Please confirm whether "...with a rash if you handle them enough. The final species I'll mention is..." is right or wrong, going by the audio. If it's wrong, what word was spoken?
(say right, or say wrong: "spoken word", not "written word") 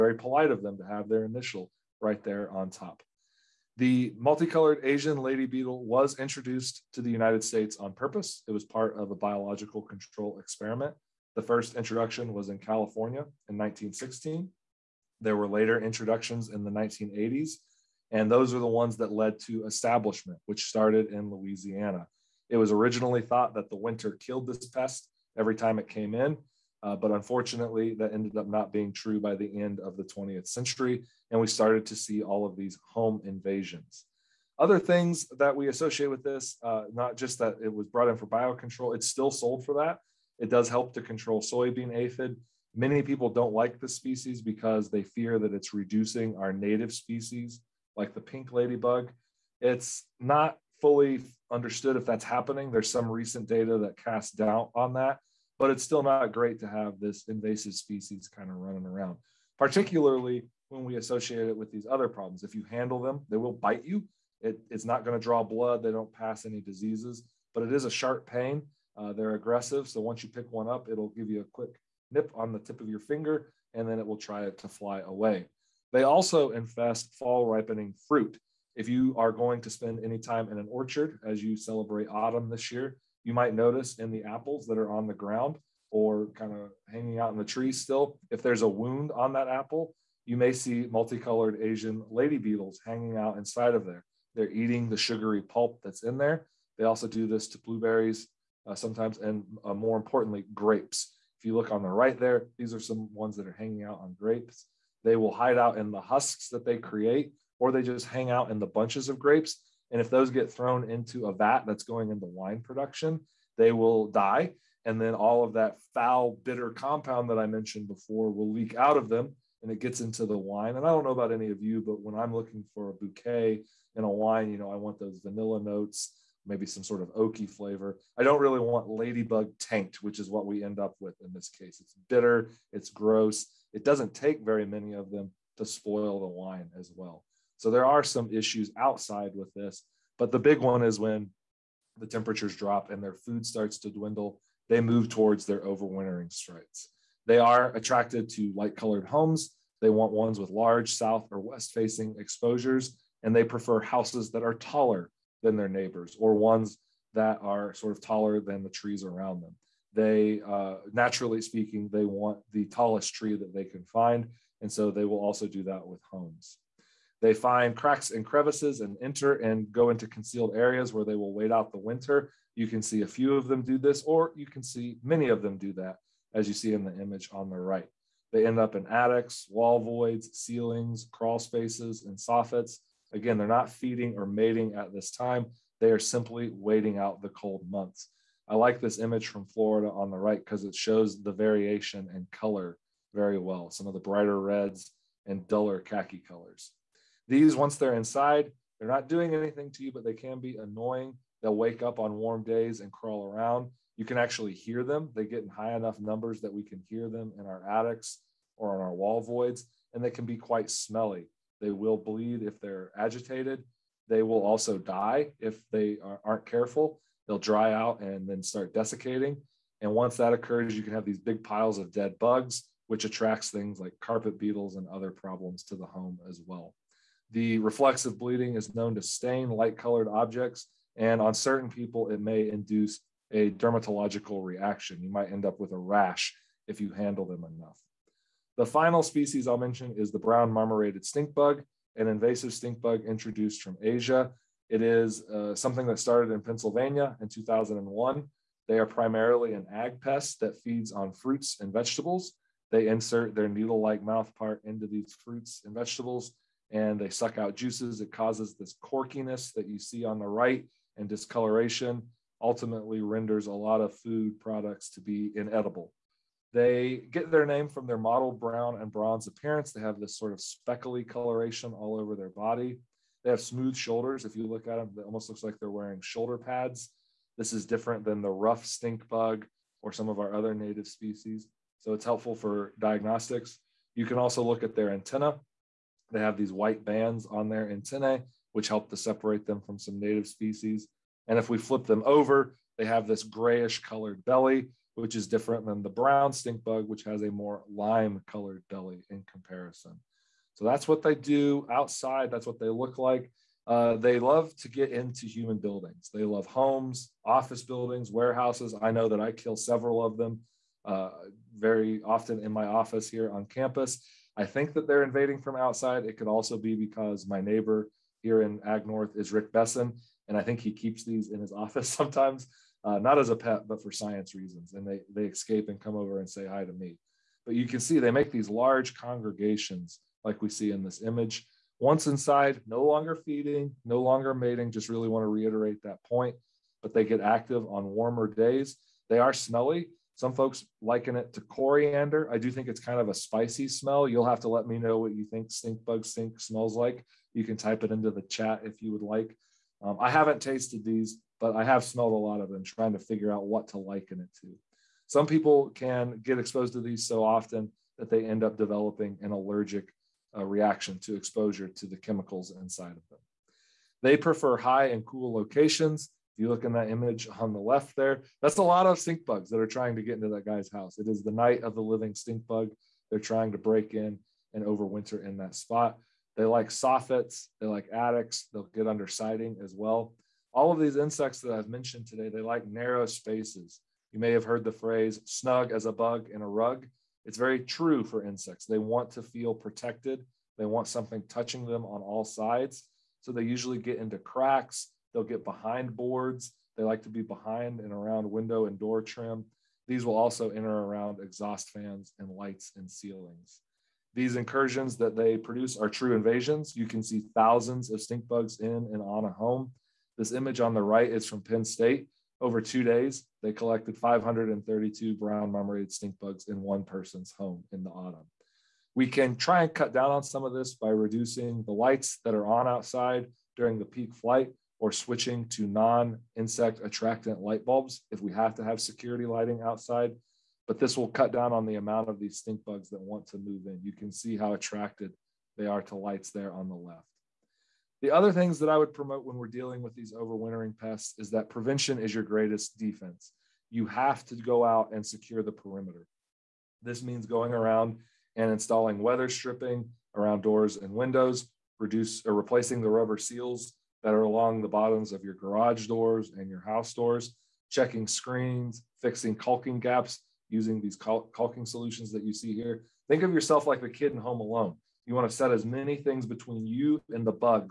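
right.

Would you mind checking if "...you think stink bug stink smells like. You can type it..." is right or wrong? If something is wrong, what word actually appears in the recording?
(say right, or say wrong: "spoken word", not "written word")
right.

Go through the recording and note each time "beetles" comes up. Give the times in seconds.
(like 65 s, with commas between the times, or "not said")
5 s, 92 s, 224 s.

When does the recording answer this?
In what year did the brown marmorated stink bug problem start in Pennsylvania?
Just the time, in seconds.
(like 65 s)
247 s.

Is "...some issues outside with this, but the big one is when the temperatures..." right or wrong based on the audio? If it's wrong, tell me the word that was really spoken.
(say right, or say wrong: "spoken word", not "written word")
right.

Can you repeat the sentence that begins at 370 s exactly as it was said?
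It is the night of the living stink bug.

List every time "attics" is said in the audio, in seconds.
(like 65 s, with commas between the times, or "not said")
178 s, 207 s, 377 s.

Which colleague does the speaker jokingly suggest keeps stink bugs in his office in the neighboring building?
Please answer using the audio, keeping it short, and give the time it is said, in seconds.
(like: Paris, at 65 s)
Rick Bessin, at 319 s.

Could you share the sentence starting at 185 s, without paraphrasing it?
They are simply waiting out the cold months.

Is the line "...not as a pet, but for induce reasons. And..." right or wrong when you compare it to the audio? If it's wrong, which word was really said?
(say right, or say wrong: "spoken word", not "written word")
wrong: "science", not "induce".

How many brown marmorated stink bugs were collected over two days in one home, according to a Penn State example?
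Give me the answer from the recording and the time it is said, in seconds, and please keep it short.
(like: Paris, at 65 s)
532, at 413 s.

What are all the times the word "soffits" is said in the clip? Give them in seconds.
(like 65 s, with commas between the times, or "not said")
182 s, 376 s.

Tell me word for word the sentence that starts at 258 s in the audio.
It causes this corkiness that you see on the right and discoloration, ultimately renders a lot of food products to be inedible.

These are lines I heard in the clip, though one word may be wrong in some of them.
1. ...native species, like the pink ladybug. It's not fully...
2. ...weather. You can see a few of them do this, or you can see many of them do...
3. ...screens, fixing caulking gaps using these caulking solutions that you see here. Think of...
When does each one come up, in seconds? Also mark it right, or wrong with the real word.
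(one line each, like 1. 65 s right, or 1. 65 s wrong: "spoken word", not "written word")
1. 46 s right
2. 171 s wrong: "winter", not "weather"
3. 458 s right.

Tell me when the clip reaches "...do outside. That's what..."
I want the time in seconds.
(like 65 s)
301 s.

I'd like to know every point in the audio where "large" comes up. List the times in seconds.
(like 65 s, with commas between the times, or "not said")
150 s, 328 s.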